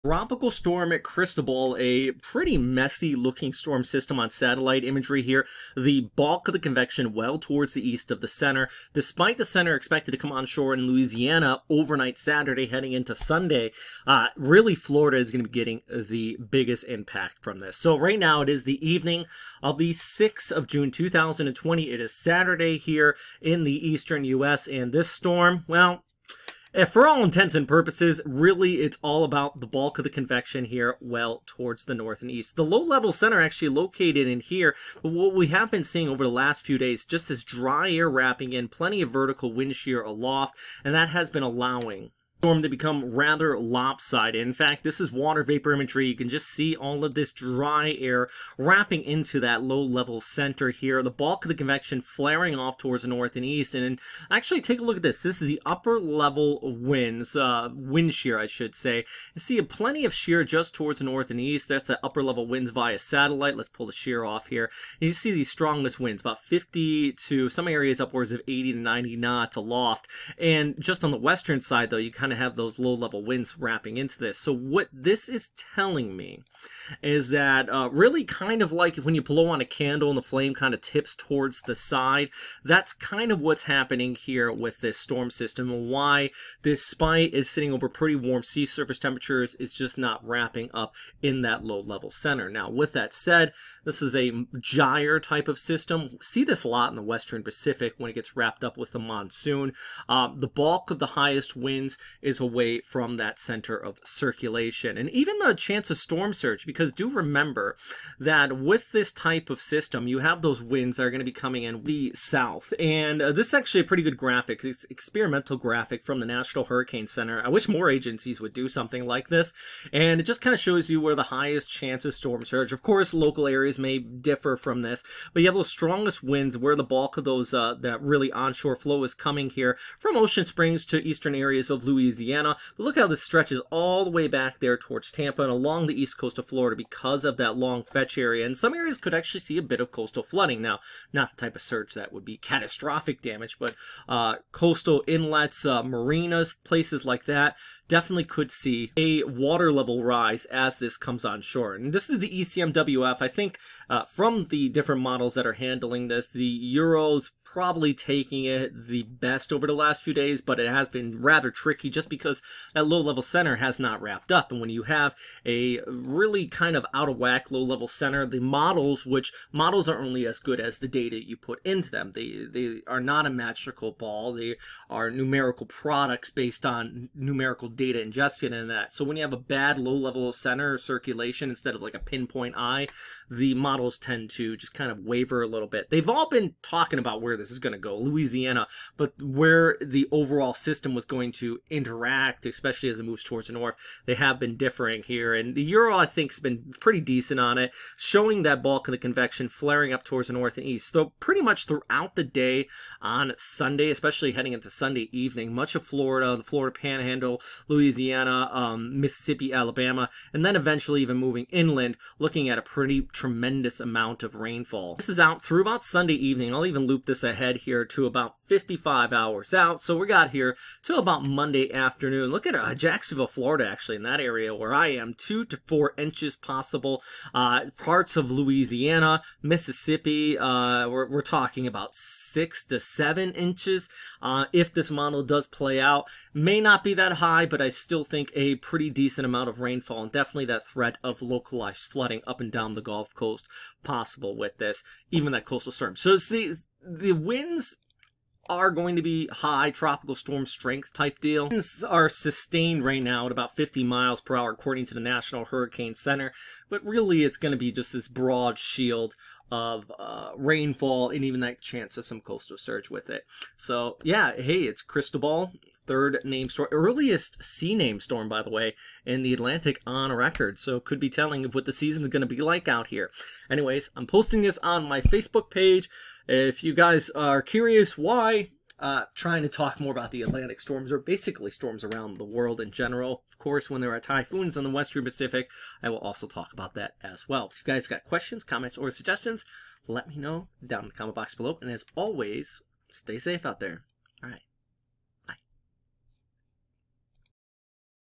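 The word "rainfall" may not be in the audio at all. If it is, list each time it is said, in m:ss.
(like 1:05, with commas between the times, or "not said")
3:34, 3:59, 4:20.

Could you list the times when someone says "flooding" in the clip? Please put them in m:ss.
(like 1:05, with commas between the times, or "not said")
2:20, 4:01.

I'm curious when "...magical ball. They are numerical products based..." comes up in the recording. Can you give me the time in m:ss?
2:53.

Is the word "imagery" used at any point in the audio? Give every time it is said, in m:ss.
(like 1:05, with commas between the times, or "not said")
0:04, 0:45.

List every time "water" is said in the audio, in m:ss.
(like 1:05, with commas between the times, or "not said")
0:45, 2:29.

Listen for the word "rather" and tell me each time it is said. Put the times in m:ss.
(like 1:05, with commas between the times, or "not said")
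0:43, 2:41.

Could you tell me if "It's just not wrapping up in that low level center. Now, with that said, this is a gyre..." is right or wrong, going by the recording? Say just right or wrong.
right.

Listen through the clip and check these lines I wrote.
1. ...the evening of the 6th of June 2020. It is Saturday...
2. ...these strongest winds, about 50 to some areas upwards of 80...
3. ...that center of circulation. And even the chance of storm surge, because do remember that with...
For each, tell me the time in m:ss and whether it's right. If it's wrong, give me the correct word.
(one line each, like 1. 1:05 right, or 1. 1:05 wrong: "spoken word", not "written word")
1. 0:18 right
2. 1:05 right
3. 1:43 right.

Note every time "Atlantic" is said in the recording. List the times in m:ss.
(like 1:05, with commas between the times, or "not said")
4:29, 4:40.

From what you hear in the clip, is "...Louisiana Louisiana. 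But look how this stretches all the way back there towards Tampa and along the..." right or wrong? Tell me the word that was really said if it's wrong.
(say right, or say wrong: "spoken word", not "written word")
right.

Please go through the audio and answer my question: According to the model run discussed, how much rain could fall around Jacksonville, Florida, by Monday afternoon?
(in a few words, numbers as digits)
2 to 4 inches.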